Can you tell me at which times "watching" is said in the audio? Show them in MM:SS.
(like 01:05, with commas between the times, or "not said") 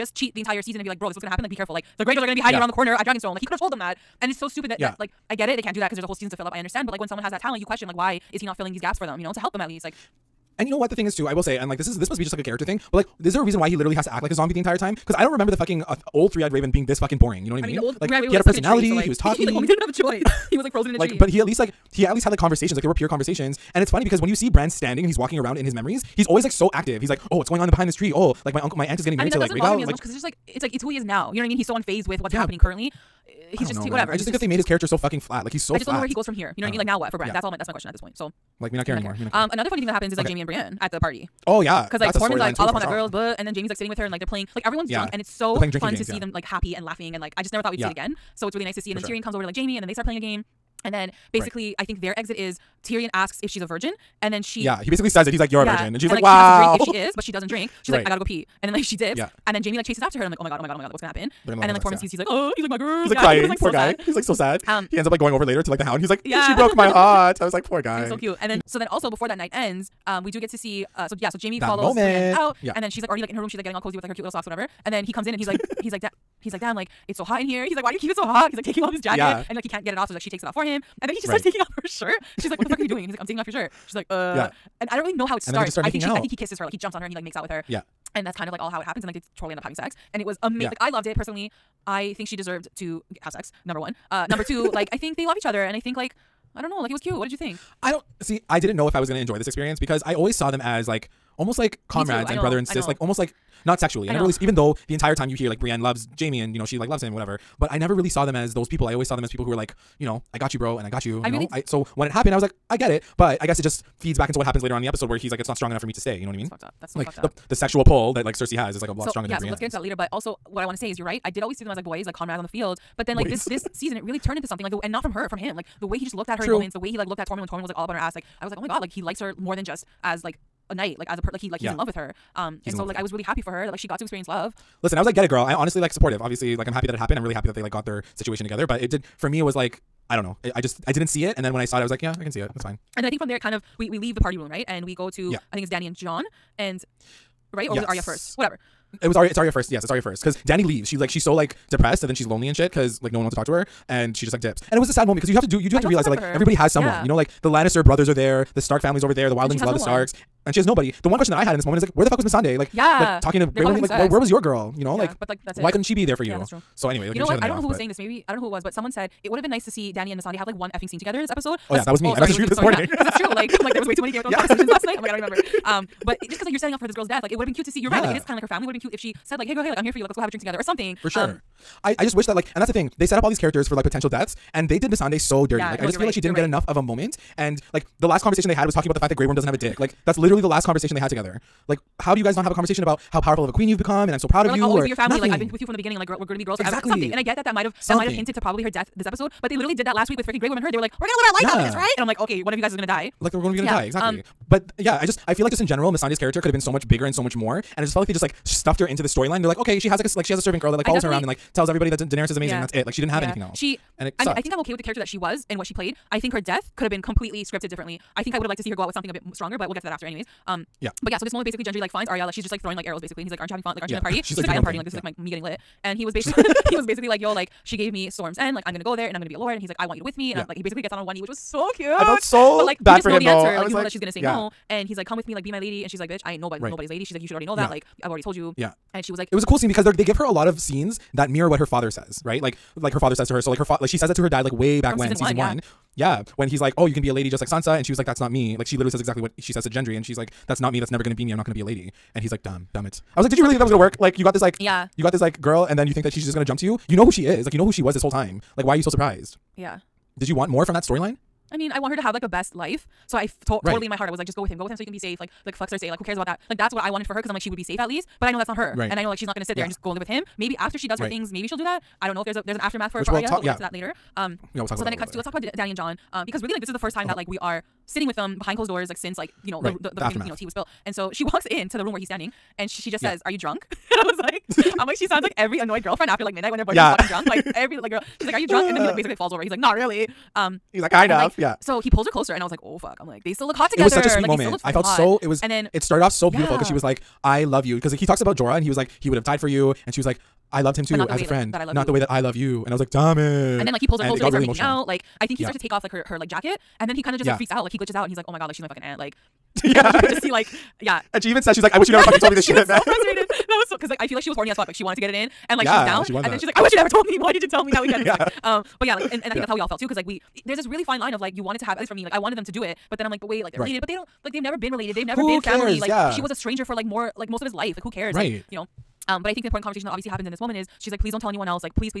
not said.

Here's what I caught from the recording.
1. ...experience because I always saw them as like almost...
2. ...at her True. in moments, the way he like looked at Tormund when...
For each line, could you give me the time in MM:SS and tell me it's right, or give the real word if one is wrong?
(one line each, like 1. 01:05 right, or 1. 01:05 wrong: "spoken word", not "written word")
1. 01:39 right
2. 02:06 right.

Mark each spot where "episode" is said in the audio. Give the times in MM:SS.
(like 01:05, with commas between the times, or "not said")
01:54, 02:51, 03:19.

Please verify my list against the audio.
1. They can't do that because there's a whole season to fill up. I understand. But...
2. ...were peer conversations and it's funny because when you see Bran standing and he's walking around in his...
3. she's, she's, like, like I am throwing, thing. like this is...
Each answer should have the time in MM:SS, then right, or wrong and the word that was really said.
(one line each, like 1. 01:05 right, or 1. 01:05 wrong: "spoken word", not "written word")
1. 00:05 right
2. 00:22 right
3. 03:44 wrong: "partying", not "throwing".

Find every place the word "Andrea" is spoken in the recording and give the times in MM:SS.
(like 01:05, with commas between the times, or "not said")
not said.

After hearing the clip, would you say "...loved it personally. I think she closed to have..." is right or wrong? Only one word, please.
wrong.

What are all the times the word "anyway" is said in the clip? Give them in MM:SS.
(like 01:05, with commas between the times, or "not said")
02:46, 03:40.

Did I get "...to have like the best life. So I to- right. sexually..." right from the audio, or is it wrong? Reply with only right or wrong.
wrong.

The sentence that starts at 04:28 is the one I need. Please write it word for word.
But I know that's not her, right?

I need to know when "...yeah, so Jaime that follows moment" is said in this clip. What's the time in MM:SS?
01:11.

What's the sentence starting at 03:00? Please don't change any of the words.
Like let's go have a drink together" or something.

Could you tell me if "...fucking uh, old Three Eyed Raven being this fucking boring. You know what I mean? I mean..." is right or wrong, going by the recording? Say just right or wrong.
right.